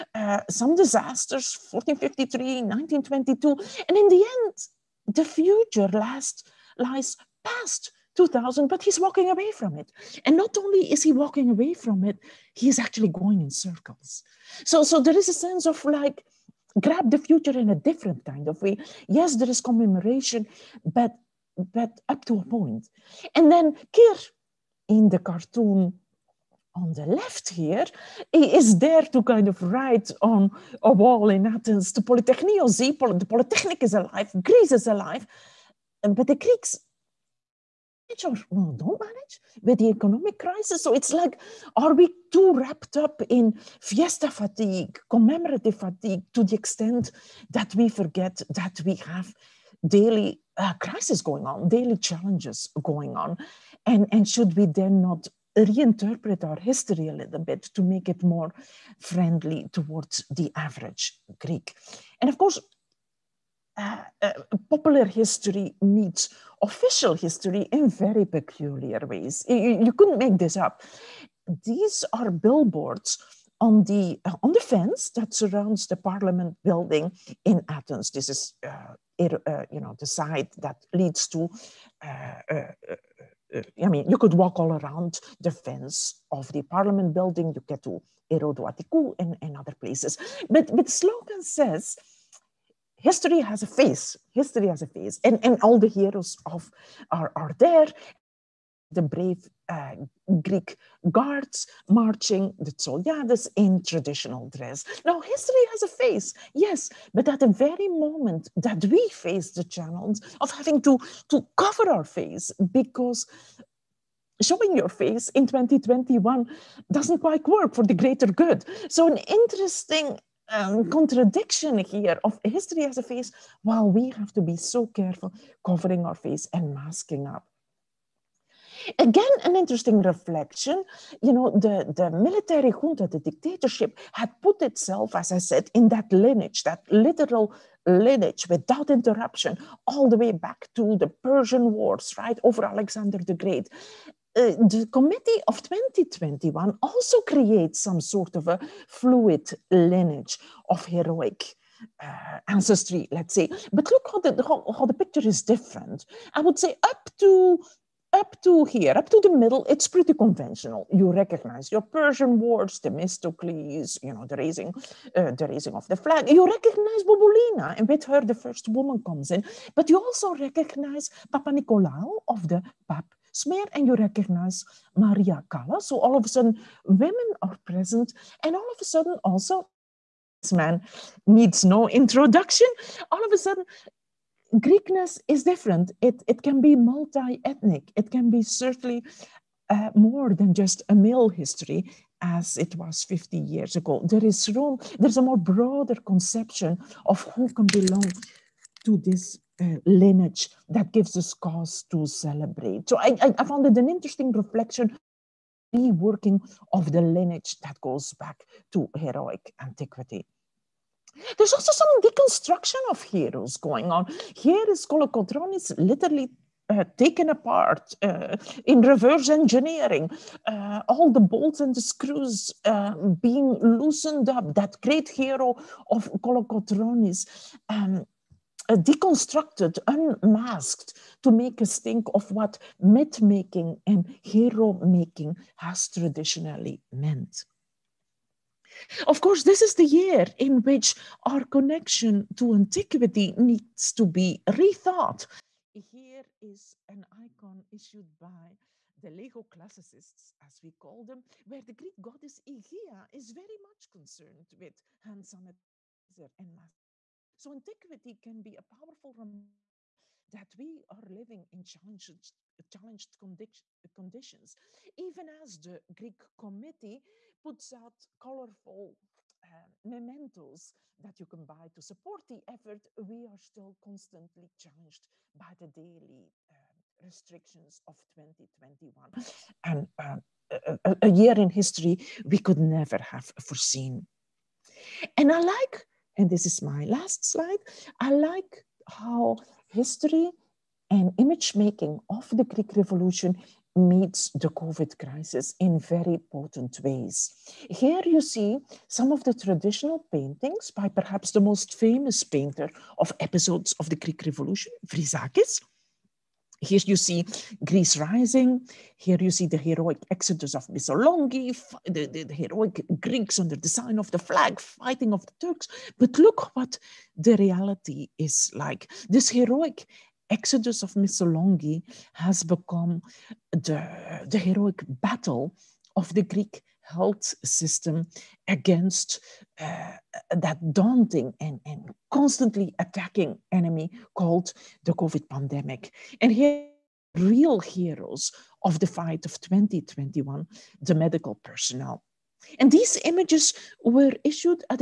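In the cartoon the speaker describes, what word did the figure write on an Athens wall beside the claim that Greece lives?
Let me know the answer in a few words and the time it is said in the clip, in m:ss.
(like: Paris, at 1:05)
Polytechnion, at 0:32.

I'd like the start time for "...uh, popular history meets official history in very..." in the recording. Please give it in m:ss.
1:04.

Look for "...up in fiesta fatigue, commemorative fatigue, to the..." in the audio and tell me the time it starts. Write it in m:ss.
0:42.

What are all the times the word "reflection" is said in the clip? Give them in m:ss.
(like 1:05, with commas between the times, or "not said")
2:10, 3:24.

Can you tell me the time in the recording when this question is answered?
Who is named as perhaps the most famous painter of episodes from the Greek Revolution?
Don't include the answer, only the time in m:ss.
5:04.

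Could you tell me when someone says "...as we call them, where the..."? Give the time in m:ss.
4:10.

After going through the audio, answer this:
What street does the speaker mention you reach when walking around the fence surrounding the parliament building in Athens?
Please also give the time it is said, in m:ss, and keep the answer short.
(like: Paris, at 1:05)
Irodou Attikou, at 1:28.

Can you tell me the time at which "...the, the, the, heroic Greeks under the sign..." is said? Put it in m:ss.
5:11.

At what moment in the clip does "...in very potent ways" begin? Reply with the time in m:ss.
4:55.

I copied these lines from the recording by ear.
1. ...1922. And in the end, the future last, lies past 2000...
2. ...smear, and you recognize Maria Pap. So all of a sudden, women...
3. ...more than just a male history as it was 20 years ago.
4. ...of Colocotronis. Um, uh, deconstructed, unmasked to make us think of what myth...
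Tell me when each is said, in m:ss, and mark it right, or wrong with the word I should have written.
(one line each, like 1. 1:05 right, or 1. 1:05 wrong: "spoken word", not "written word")
1. 0:02 right
2. 2:53 wrong: "Callas", not "Pap"
3. 3:09 wrong: "50", not "20"
4. 3:45 right.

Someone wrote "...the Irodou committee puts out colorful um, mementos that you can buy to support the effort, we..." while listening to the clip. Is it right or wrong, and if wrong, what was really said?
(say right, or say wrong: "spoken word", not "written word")
wrong: "Greek", not "Irodou".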